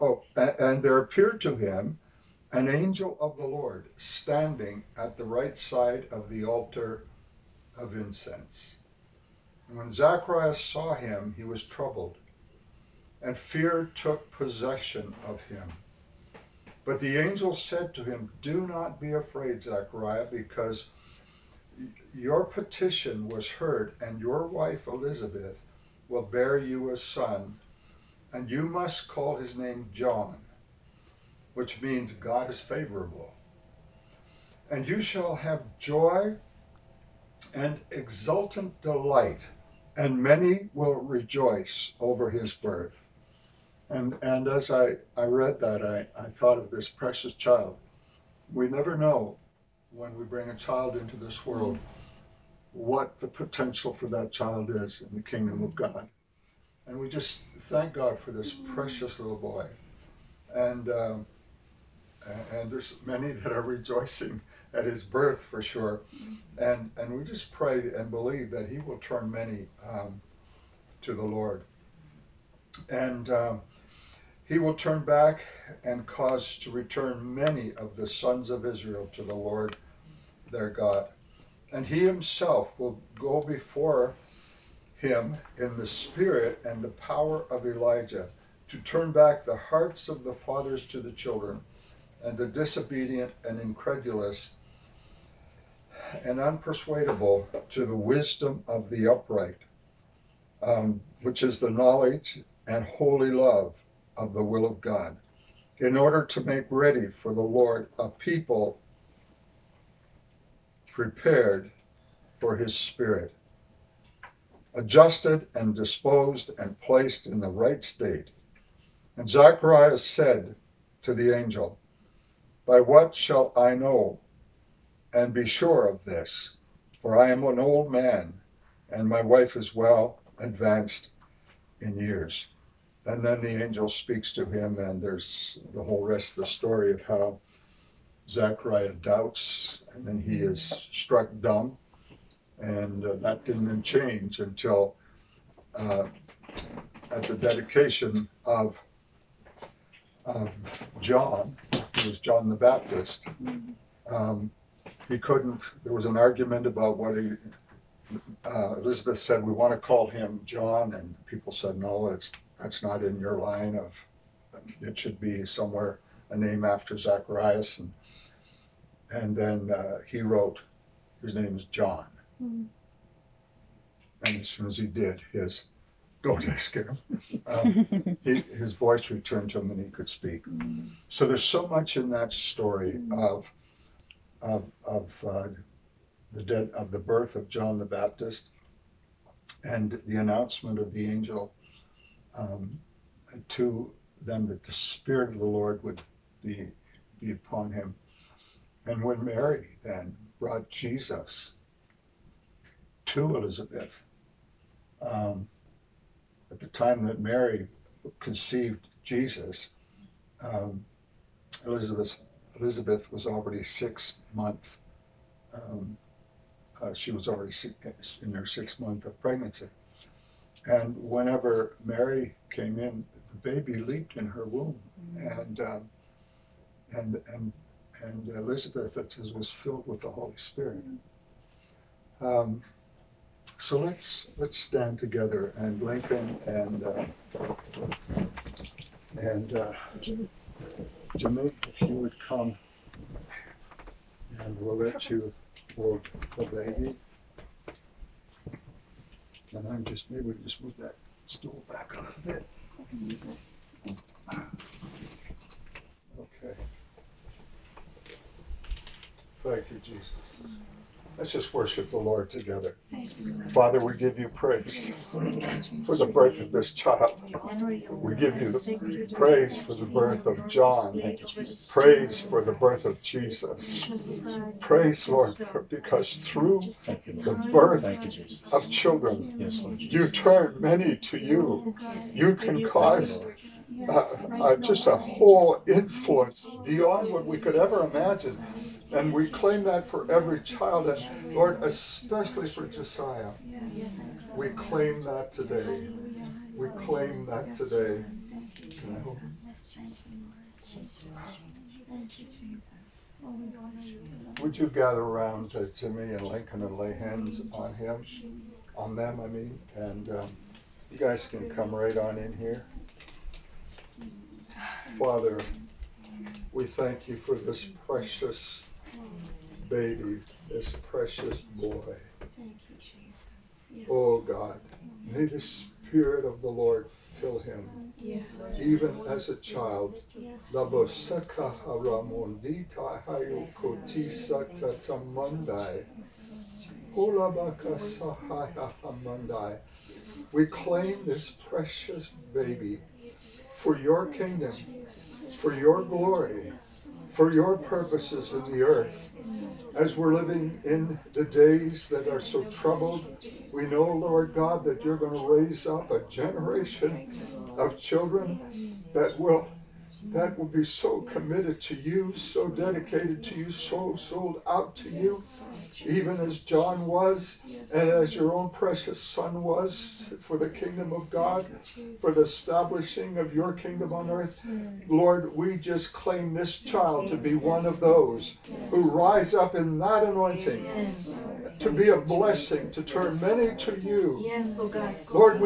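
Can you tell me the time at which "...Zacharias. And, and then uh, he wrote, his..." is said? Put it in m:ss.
2:46.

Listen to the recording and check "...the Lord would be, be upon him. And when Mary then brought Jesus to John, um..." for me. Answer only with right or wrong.
wrong.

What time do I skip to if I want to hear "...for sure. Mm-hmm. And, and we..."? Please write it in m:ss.
1:05.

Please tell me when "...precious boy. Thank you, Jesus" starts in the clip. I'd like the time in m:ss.
5:20.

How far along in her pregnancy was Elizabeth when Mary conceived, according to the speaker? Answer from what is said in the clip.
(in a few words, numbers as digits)
6 months.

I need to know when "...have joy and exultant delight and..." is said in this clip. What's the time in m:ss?
0:35.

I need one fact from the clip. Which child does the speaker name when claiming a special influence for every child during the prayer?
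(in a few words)
Jasiah.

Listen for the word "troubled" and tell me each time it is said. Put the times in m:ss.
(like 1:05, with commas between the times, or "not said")
0:11, 5:52.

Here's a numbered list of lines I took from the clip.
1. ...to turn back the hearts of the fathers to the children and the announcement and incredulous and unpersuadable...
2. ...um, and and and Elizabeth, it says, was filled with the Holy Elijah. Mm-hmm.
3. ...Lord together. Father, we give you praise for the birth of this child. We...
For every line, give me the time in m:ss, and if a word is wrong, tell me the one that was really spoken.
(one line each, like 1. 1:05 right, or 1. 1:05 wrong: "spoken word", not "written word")
1. 1:28 wrong: "disobedient", not "announcement"
2. 3:45 wrong: "Spirit", not "Elijah"
3. 4:21 right.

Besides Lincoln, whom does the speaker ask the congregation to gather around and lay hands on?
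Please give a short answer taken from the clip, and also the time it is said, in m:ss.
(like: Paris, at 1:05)
Jimi, at 5:05.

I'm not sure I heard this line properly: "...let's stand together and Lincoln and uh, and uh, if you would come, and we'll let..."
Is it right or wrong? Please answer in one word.
right.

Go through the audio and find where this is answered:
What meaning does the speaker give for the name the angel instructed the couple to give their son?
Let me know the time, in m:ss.
0:32.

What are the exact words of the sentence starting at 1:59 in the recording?
And Zacharias said to the angel, by what shall I know and be sure of this?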